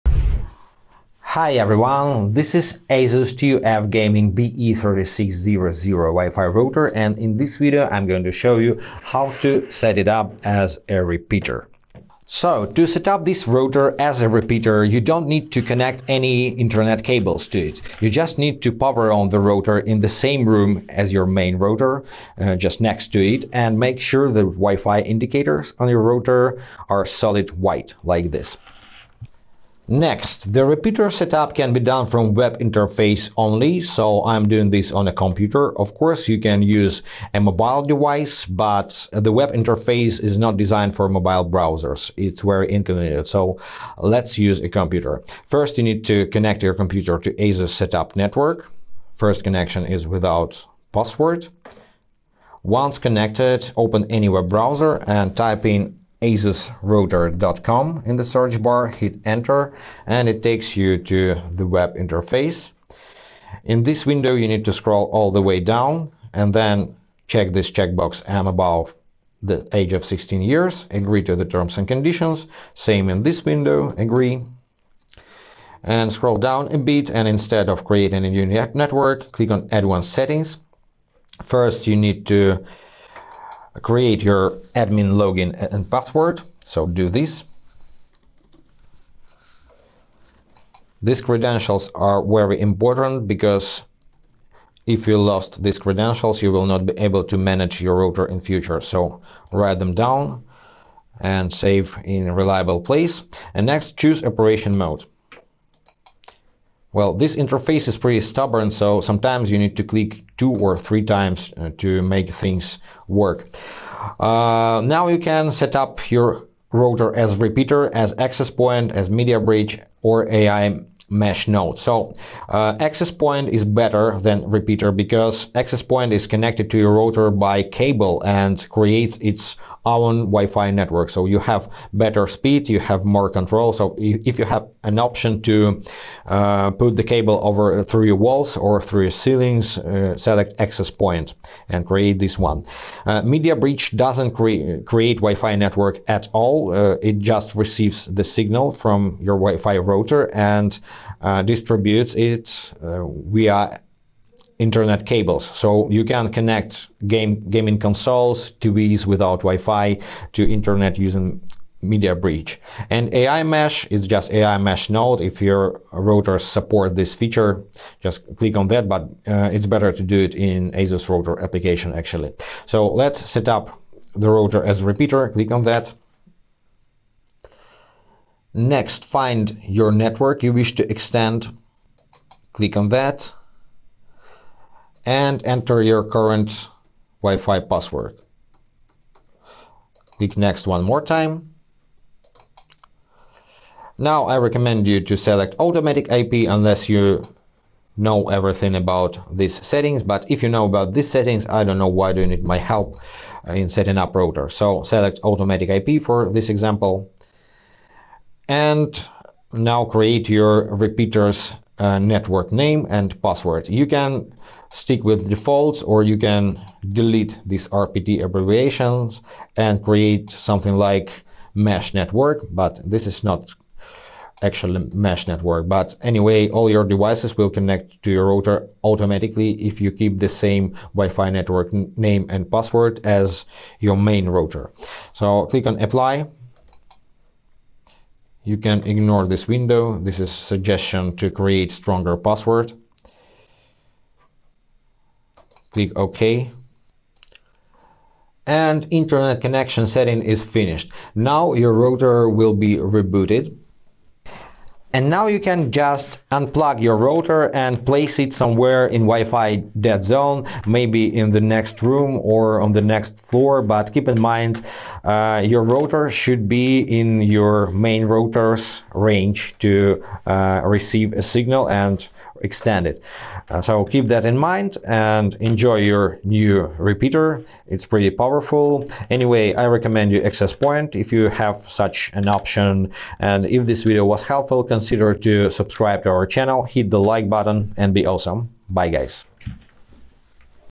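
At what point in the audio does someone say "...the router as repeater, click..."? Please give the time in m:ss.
2:54.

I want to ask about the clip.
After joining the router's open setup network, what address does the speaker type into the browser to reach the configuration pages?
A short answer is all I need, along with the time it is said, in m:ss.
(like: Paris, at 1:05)
asusrouter.com, at 0:56.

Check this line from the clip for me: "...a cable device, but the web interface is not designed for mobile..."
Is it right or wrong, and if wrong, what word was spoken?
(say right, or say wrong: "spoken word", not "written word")
wrong: "mobile", not "cable".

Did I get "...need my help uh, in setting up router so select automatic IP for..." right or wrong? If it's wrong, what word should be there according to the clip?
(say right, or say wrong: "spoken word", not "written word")
right.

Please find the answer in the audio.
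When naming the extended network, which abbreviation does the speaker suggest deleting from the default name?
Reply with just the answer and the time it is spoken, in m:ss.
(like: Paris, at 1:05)
RPT, at 3:37.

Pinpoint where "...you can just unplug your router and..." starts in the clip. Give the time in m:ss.
4:15.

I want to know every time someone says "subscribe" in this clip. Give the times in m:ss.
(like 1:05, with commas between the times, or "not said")
4:45.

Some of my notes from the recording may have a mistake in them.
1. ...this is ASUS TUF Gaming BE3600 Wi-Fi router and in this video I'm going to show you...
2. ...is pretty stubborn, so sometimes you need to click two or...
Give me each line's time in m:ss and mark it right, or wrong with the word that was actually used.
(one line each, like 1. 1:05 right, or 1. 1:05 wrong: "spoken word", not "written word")
1. 0:02 right
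2. 1:47 right.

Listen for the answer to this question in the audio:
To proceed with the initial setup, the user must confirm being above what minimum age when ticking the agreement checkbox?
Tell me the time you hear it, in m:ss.
1:10.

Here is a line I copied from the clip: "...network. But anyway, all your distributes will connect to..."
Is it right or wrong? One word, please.
wrong.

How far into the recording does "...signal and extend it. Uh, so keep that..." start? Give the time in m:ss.
4:31.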